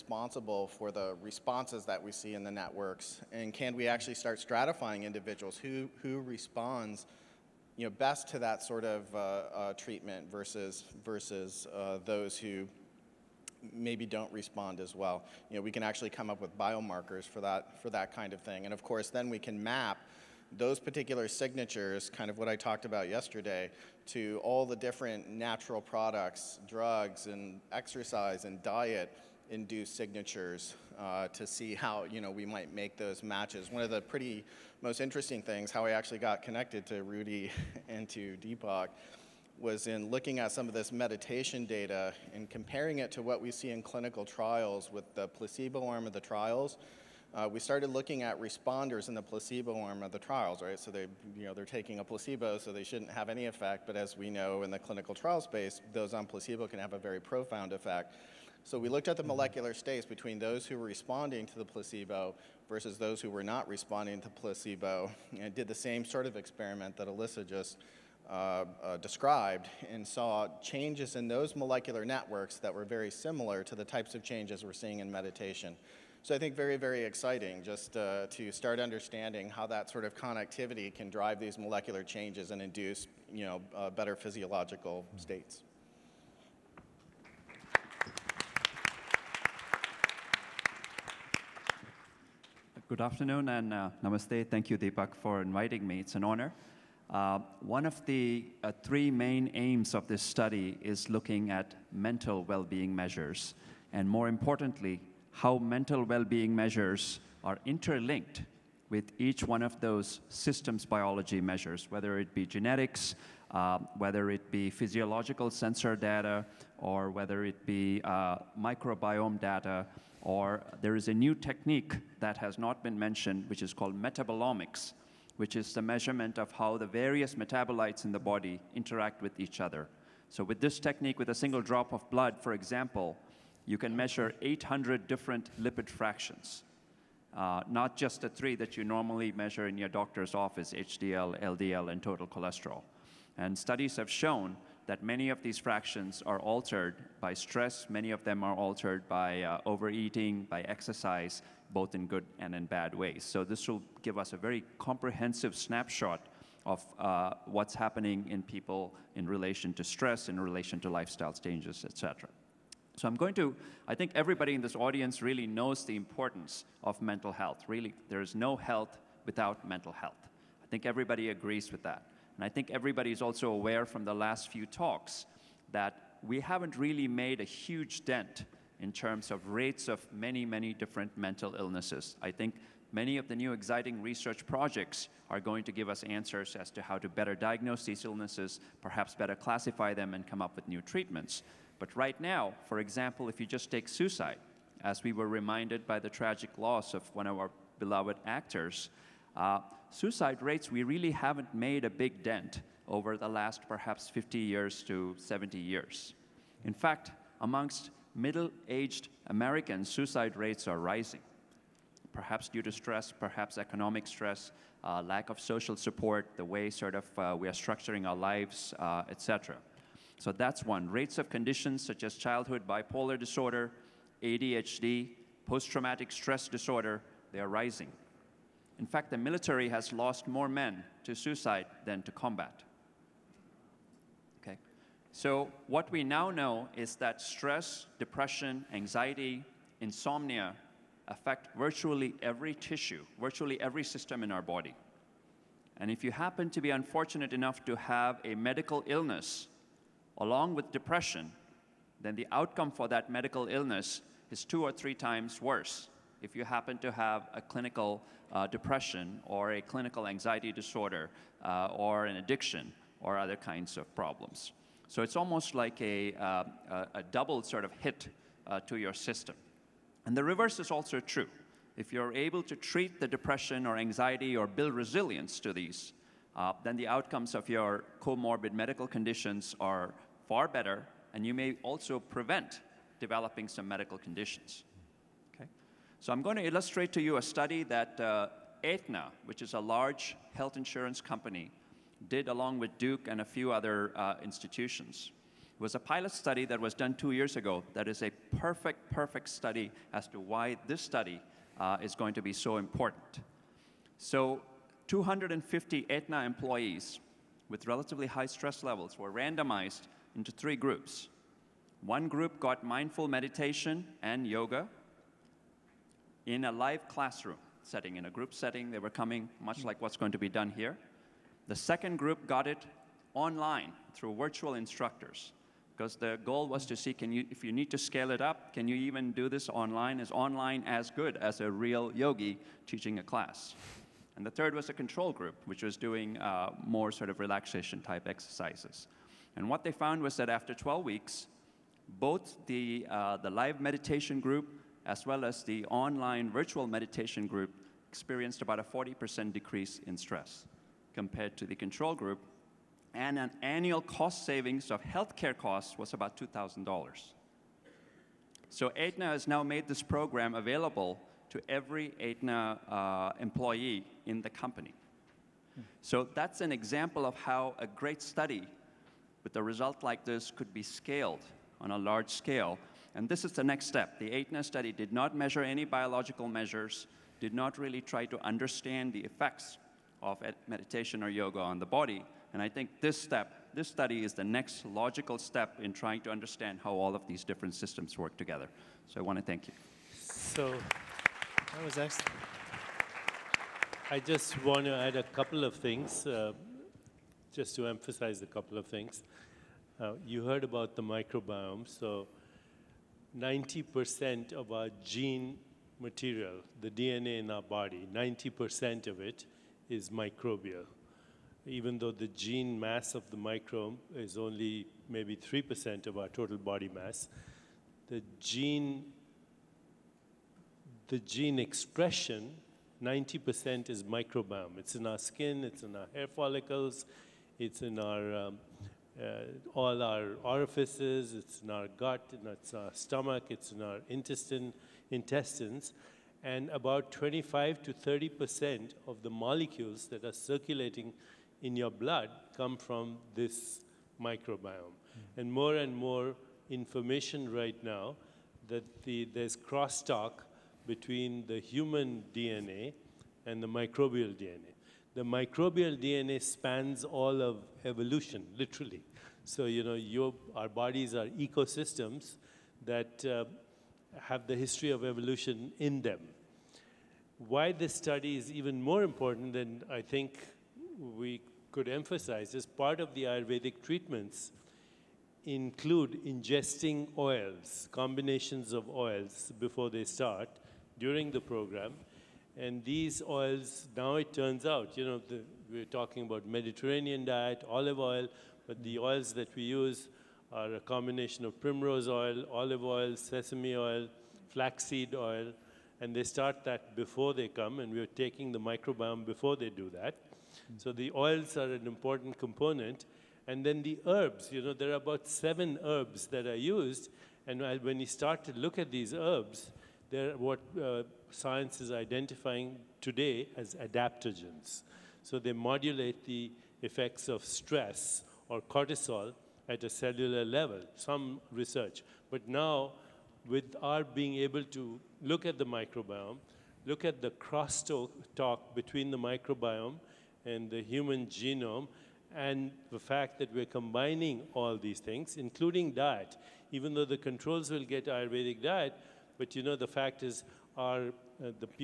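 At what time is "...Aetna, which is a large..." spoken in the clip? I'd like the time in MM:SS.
04:48.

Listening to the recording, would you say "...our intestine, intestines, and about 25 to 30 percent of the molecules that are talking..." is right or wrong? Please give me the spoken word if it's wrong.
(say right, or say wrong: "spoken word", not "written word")
wrong: "circulating", not "talking".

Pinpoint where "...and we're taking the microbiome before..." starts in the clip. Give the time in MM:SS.
08:17.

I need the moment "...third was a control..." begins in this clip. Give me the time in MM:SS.
05:34.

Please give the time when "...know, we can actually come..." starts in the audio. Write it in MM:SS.
00:15.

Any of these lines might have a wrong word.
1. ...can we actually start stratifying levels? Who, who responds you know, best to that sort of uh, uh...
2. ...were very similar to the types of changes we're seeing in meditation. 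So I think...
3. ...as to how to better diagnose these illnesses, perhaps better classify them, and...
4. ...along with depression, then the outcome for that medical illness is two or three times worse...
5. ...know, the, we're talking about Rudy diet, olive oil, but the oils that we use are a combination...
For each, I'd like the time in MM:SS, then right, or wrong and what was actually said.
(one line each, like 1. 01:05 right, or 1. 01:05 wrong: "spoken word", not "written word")
1. 00:03 wrong: "individuals", not "levels"
2. 01:12 right
3. 03:06 right
4. 04:10 right
5. 08:04 wrong: "Mediterranean", not "Rudy".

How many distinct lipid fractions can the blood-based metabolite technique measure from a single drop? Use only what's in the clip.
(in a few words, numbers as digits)
800.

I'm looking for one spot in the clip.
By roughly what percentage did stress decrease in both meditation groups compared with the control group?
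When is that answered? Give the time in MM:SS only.
05:48.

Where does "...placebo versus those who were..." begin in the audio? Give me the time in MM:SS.
01:01.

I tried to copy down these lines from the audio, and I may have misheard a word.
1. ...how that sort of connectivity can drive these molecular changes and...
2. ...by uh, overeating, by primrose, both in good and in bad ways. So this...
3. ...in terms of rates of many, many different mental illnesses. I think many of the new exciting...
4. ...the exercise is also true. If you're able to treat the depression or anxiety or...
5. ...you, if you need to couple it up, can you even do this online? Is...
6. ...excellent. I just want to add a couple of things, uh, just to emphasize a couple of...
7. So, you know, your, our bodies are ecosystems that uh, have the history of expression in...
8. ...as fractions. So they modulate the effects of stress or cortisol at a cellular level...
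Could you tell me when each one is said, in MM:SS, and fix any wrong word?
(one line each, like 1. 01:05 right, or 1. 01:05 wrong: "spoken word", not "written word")
1. 01:19 right
2. 02:29 wrong: "exercise", not "primrose"
3. 02:58 right
4. 04:30 wrong: "reverse", not "exercise"
5. 05:27 wrong: "scale", not "couple"
6. 06:31 right
7. 07:39 wrong: "evolution", not "expression"
8. 08:33 wrong: "adaptogens", not "fractions".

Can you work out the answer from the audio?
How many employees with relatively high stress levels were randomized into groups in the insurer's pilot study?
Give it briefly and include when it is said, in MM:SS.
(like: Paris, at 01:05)
250, at 05:04.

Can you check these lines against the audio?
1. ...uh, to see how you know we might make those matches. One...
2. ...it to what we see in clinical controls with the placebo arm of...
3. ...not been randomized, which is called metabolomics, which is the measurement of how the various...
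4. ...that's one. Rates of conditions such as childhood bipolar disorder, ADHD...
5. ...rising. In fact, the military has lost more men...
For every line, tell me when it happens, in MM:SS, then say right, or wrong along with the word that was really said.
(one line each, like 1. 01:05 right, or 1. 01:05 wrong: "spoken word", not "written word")
1. 00:30 right
2. 00:42 wrong: "trials", not "controls"
3. 02:02 wrong: "mentioned", not "randomized"
4. 03:40 right
5. 03:47 right.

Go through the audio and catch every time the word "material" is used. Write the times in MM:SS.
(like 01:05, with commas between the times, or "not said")
06:45.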